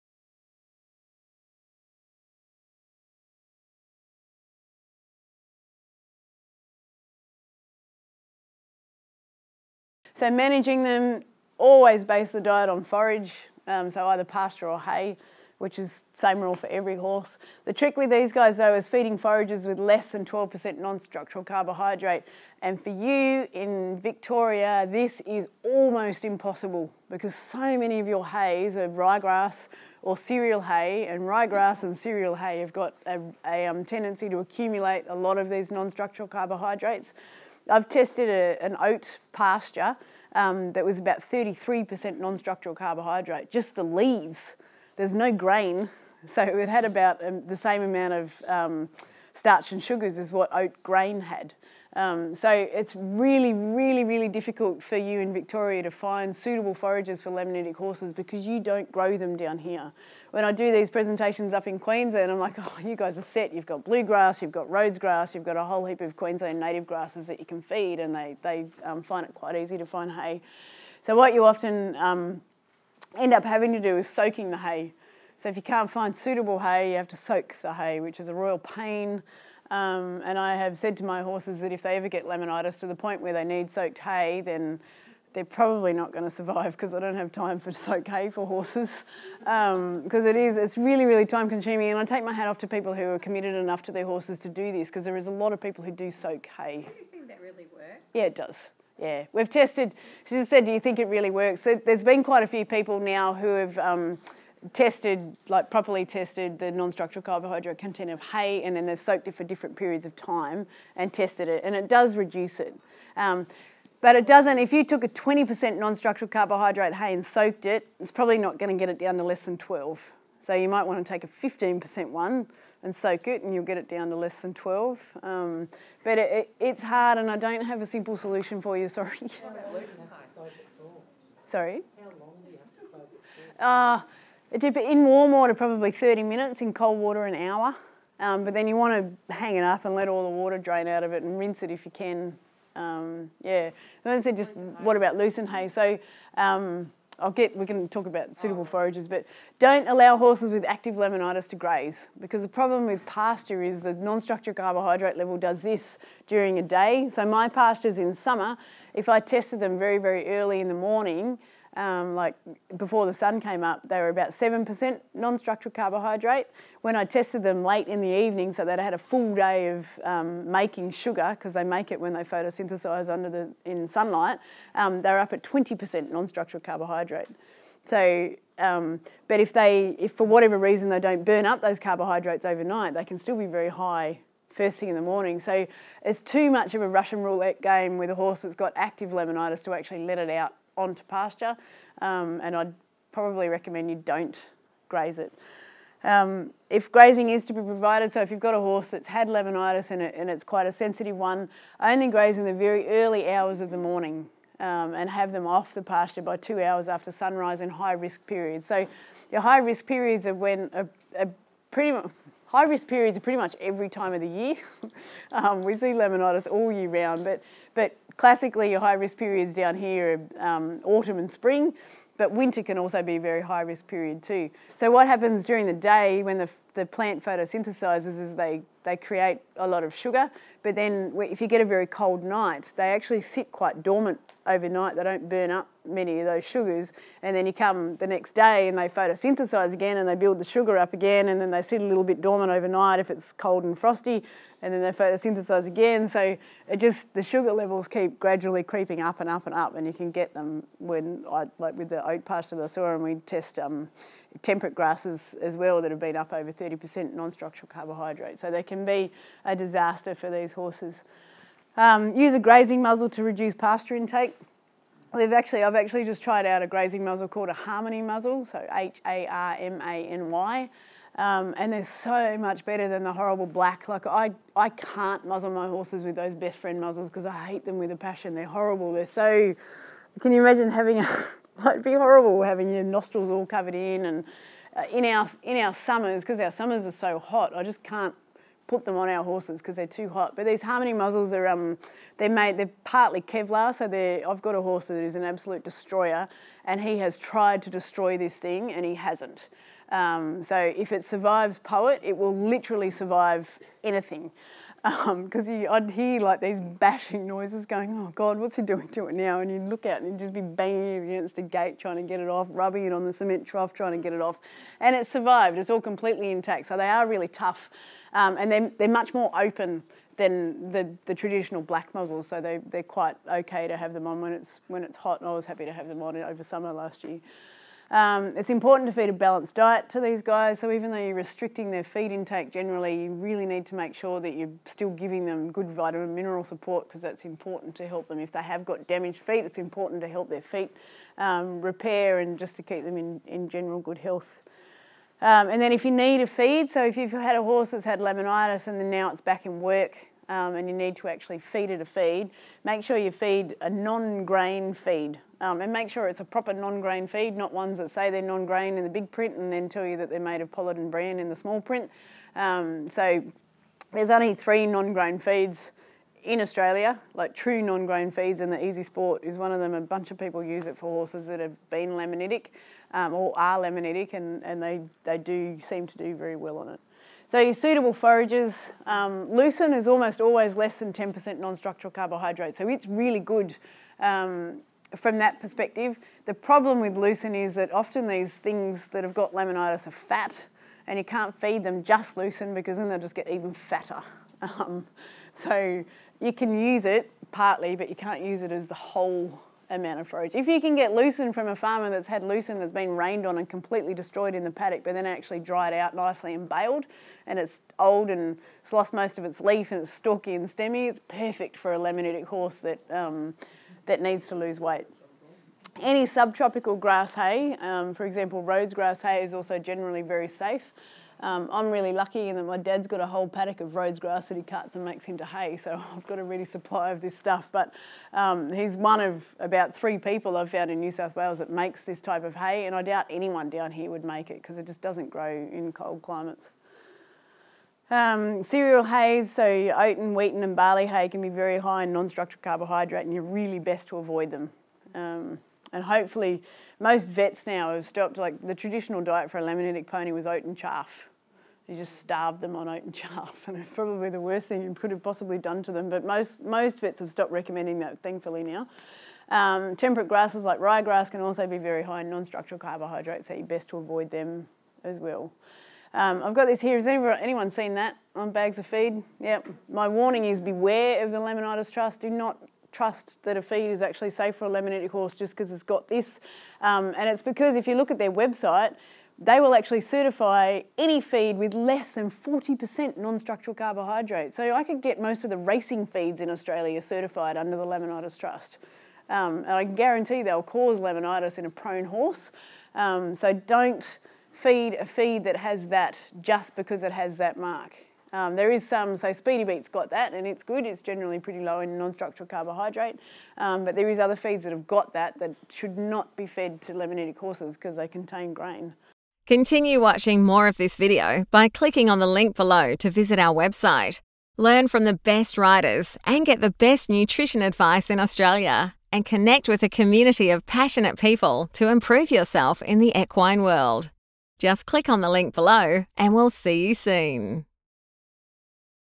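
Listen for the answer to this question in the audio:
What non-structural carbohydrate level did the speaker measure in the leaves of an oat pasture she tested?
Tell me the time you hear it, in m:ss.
0:41.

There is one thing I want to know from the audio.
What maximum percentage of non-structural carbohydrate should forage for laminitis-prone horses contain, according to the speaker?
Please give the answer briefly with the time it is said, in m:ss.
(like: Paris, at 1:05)
12%, at 0:19.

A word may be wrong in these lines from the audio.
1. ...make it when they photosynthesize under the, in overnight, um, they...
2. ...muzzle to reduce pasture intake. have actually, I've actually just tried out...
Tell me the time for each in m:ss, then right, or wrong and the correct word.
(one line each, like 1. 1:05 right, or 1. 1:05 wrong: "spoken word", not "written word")
1. 2:51 wrong: "sunlight", not "overnight"
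2. 4:22 right.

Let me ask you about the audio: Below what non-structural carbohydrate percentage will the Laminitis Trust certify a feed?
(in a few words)
40%.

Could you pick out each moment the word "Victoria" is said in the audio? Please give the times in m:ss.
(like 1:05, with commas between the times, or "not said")
0:23, 0:55.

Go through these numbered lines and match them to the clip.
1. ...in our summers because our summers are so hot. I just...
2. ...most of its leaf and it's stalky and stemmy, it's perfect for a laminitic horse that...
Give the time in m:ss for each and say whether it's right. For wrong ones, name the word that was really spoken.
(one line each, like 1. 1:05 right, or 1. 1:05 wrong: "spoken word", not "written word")
1. 4:45 right
2. 6:48 right.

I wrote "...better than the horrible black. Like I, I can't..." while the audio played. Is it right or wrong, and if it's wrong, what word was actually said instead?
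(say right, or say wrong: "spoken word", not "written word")
right.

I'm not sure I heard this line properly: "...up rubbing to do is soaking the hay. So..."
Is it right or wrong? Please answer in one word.
wrong.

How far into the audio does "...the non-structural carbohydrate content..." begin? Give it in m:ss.
1:46.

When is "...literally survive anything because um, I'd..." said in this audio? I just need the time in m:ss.
5:02.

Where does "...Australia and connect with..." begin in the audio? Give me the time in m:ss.
8:37.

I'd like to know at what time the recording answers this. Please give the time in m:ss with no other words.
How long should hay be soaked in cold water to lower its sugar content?
2:16.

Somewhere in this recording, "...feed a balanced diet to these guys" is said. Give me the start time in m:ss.
5:28.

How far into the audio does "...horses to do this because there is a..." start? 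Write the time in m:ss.
1:34.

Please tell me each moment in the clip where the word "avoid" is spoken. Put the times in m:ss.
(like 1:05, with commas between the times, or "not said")
7:23, 7:43.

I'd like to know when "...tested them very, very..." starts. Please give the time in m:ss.
2:39.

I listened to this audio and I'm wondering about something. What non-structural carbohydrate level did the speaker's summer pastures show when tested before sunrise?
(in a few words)
7%.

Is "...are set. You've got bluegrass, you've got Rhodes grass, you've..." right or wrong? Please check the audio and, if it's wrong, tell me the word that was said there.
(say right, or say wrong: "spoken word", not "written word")
right.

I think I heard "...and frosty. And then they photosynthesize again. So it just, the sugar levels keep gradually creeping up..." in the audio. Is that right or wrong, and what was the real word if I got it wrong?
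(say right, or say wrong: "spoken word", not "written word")
right.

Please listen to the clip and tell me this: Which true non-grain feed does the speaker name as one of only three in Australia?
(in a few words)
EasiSport.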